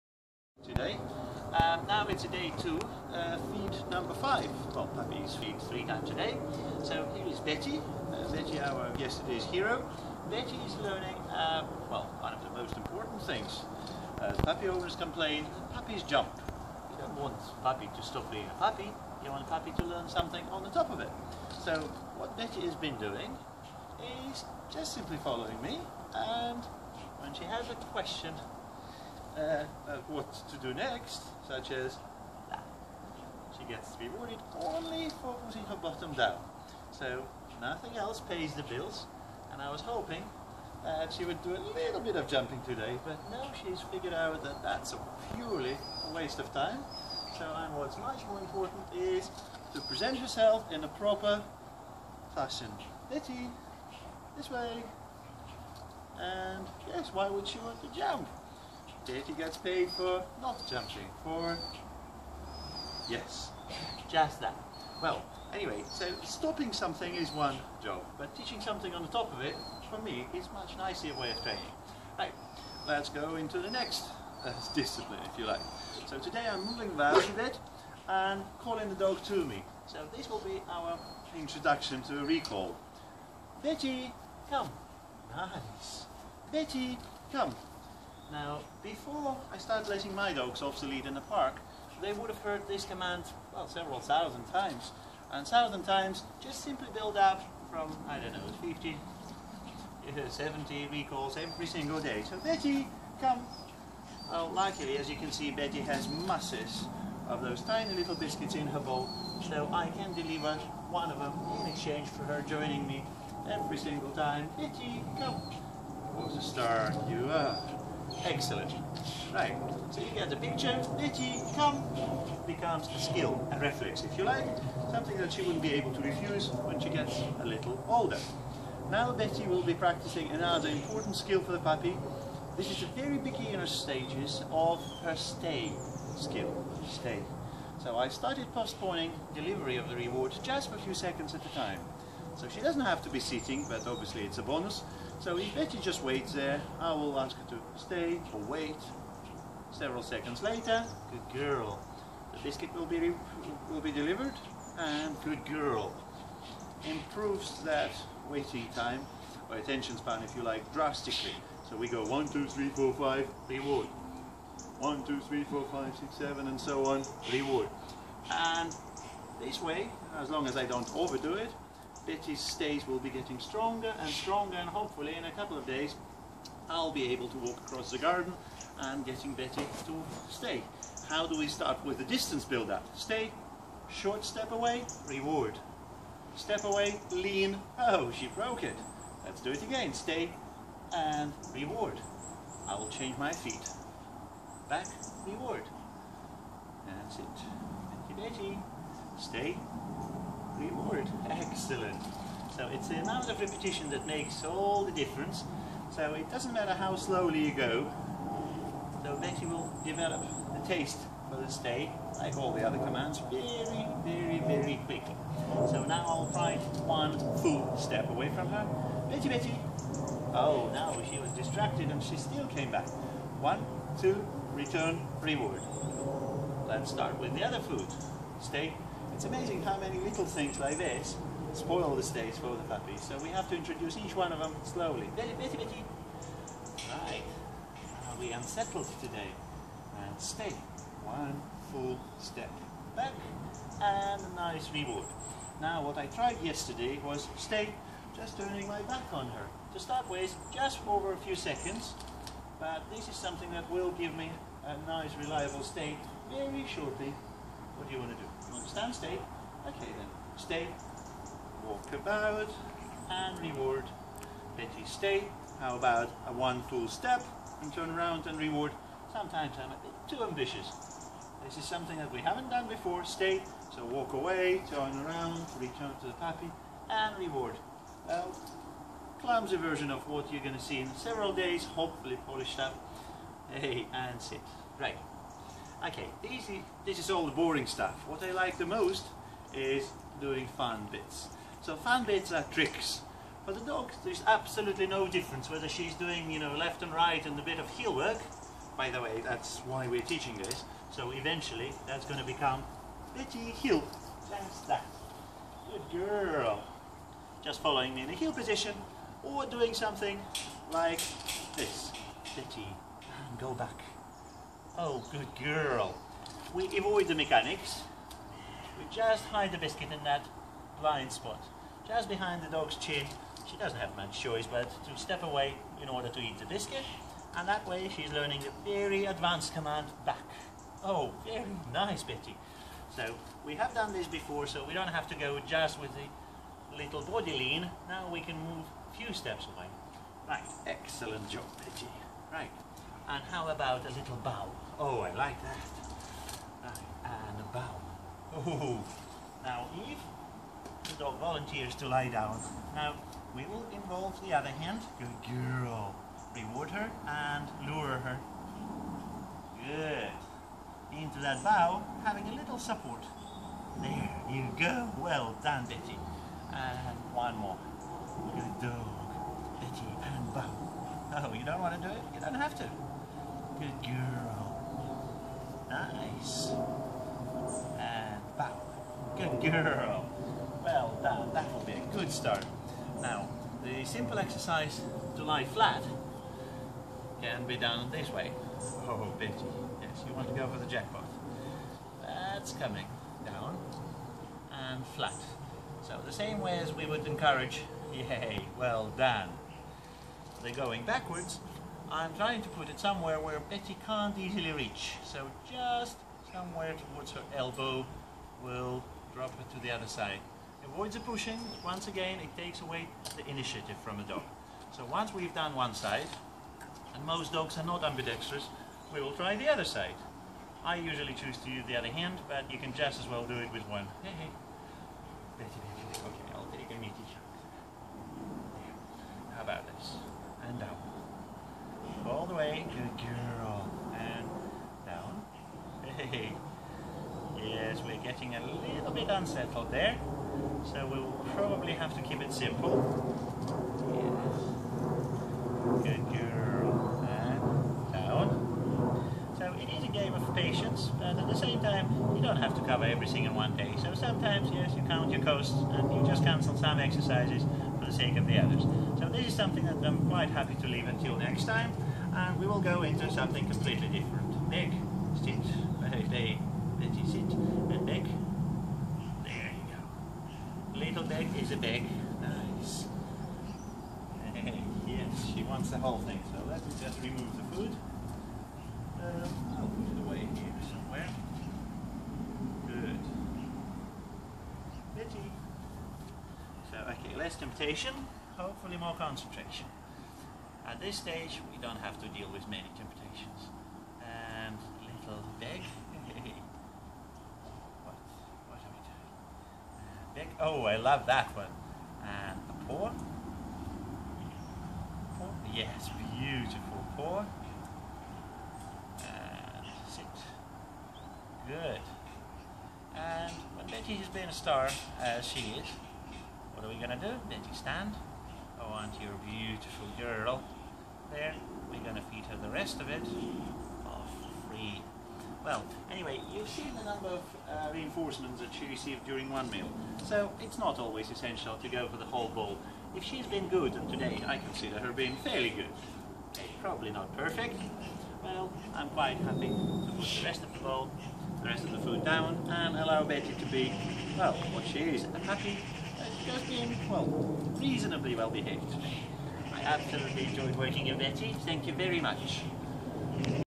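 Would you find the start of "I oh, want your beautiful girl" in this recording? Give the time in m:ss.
8:38.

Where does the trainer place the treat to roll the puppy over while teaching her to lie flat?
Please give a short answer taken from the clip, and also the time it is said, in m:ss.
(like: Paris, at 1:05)
Towards her elbow, at 6:46.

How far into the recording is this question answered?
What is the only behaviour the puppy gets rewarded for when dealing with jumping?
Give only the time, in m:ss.
0:35.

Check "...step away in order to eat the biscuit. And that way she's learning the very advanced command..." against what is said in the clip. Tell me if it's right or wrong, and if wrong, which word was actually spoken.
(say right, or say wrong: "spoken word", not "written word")
right.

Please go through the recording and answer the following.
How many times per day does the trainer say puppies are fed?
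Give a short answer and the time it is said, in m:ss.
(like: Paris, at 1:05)
3, at 0:05.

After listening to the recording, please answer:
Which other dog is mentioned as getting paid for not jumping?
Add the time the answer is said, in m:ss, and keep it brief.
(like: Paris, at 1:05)
Katie, at 0:59.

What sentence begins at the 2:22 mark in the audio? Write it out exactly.
So she doesn't have to be sitting, but obviously it's a bonus.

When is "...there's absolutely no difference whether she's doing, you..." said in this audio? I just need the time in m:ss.
4:54.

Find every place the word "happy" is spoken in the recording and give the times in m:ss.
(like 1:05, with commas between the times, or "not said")
7:40, 8:59, 9:05.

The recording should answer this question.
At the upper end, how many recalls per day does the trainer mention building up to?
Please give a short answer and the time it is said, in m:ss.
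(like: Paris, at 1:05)
70, at 1:40.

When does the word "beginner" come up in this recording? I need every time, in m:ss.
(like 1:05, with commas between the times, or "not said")
2:13.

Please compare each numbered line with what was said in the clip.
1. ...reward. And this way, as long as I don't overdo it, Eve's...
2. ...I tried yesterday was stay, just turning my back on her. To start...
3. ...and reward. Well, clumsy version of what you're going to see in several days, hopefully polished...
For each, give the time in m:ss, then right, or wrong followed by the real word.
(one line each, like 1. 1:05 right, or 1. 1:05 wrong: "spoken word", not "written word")
1. 2:47 wrong: "Bettie", not "Eve"
2. 4:05 right
3. 4:36 right.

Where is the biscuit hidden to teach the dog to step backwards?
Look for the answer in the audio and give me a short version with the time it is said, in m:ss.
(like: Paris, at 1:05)
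Just behind the dog's chin, at 5:21.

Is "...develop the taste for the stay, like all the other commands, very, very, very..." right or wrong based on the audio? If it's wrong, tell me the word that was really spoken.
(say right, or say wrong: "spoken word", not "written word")
right.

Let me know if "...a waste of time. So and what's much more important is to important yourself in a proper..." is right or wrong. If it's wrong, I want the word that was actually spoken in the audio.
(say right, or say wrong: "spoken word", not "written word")
wrong: "present", not "important".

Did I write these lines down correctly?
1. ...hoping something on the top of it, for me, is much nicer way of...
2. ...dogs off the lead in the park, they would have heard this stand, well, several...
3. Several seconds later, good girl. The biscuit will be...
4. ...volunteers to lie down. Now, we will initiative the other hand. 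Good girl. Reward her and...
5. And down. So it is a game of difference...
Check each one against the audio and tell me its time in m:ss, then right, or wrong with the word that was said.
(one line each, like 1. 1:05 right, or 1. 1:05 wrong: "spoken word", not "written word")
1. 1:08 wrong: "teaching", not "hoping"
2. 1:30 wrong: "command", not "stand"
3. 2:29 right
4. 5:51 wrong: "involve", not "initiative"
5. 7:27 wrong: "patience", not "difference".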